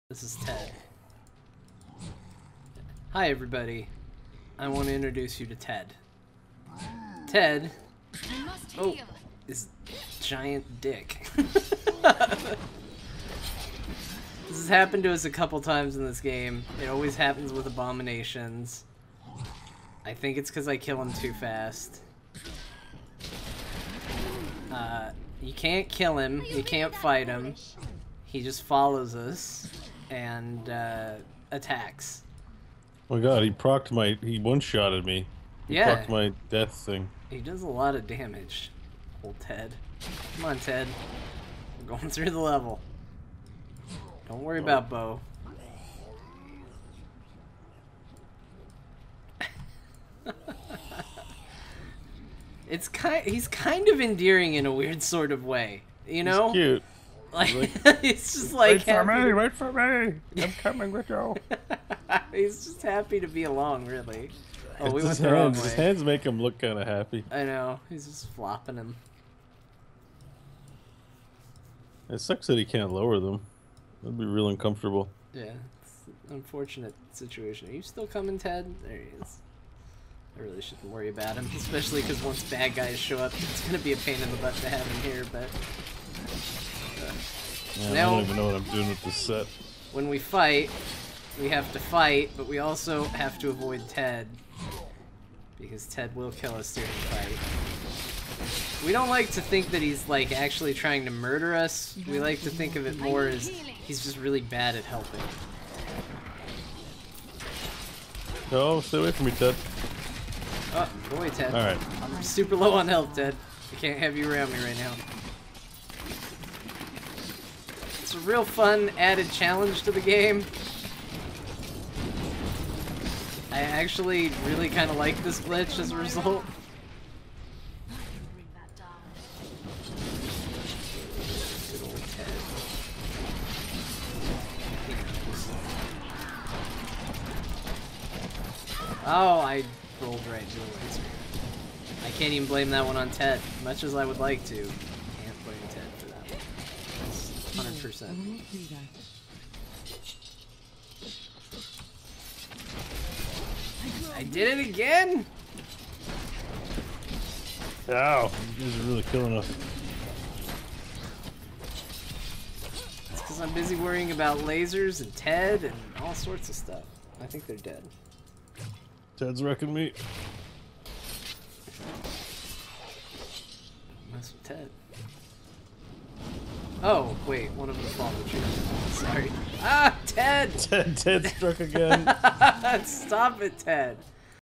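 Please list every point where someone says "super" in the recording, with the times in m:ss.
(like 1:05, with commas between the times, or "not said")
1:52.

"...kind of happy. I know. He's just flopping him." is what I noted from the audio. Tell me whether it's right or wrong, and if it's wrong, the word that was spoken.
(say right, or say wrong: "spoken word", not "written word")
right.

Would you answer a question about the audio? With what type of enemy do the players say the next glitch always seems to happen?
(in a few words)
Abominations.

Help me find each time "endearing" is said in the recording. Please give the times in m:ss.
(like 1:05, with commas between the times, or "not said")
0:53.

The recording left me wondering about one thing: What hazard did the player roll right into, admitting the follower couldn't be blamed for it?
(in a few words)
Laser.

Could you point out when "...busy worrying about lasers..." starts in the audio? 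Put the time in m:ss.
2:43.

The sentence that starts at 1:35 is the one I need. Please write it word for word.
Because Ted will kill us during the fight.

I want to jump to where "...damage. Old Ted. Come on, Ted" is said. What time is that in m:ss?
0:38.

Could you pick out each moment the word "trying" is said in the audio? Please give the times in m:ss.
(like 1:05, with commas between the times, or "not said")
1:40.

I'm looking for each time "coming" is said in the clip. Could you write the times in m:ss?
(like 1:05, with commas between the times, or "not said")
1:00, 1:18.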